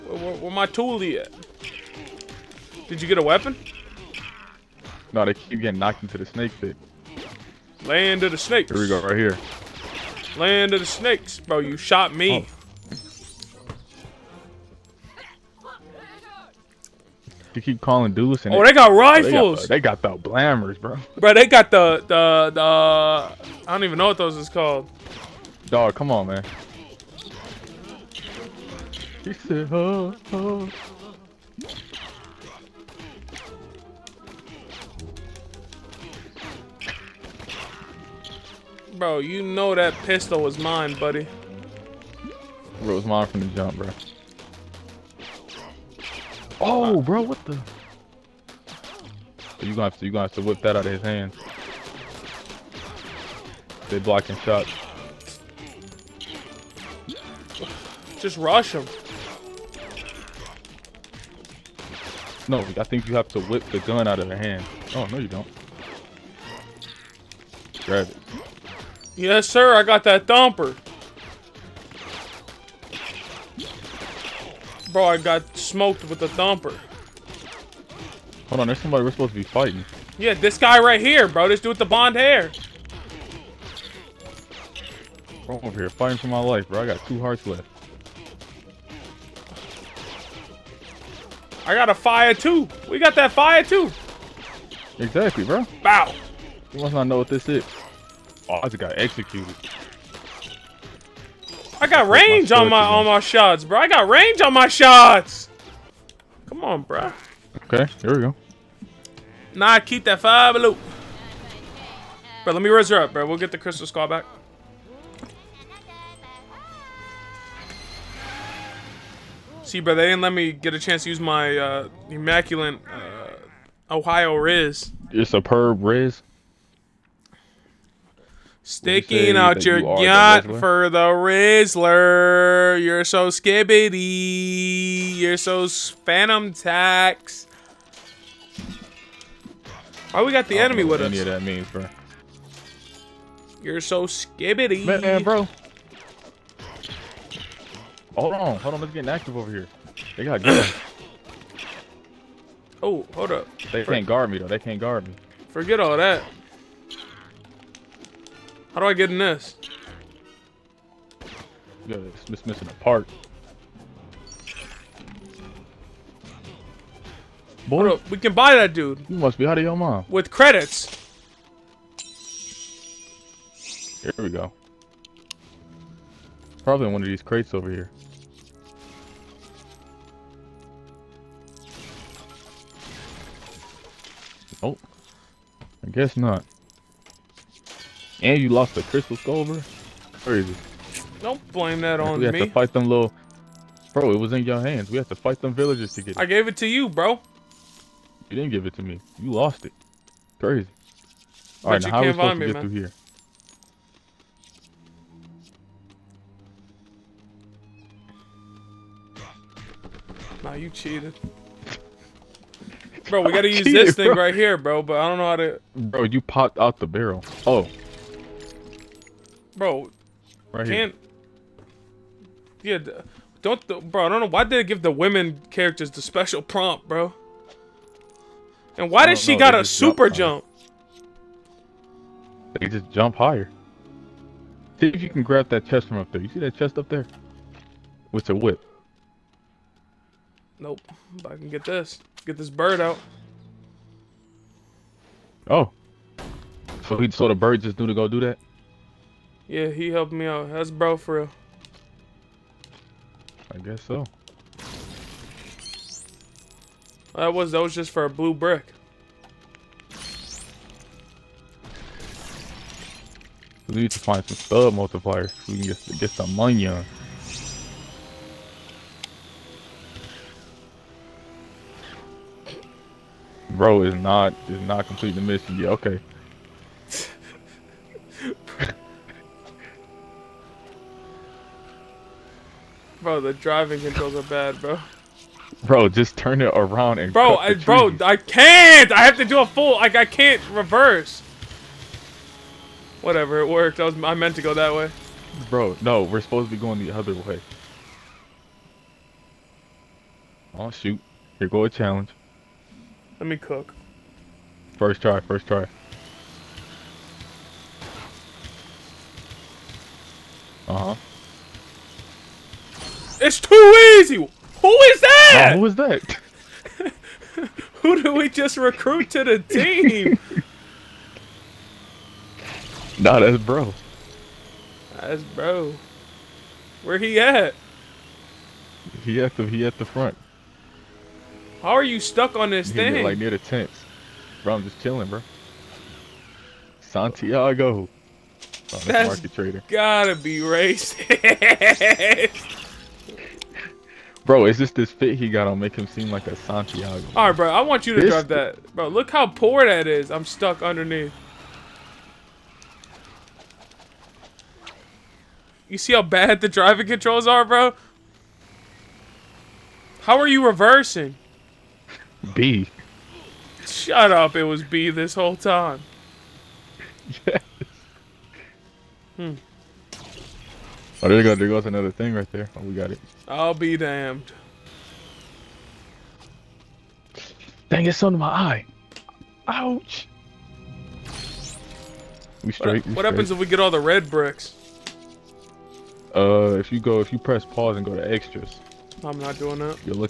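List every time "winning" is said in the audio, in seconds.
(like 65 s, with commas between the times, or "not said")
not said.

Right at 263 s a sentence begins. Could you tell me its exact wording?
We need to find some stud multipliers so we can get, get some money on.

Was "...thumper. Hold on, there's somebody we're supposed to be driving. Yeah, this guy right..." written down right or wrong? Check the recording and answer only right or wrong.
wrong.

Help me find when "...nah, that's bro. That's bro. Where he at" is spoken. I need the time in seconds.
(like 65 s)
322 s.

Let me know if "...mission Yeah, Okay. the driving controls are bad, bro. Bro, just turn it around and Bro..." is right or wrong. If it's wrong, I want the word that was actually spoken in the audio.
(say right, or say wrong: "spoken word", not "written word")
right.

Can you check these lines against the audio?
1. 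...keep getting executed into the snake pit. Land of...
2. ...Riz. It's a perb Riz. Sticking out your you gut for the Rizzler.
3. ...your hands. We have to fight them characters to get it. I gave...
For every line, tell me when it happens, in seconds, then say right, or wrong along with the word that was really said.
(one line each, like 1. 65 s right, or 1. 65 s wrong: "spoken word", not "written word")
1. 5 s wrong: "knocked", not "executed"
2. 124 s right
3. 194 s wrong: "villagers", not "characters".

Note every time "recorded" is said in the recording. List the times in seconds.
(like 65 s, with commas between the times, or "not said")
not said.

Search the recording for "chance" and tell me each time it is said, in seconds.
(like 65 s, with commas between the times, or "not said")
120 s.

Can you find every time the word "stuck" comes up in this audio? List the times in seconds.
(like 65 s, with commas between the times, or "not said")
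331 s, 350 s.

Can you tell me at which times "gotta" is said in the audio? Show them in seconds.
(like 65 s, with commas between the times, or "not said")
213 s, 339 s.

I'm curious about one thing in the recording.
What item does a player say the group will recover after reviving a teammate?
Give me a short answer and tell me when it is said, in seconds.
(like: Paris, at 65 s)
crystal skull, at 113 s.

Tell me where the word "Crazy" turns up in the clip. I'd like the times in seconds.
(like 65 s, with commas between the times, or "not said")
190 s, 200 s.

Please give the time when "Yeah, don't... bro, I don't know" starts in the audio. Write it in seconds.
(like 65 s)
222 s.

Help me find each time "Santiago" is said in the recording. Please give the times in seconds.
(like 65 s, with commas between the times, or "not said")
336 s, 346 s.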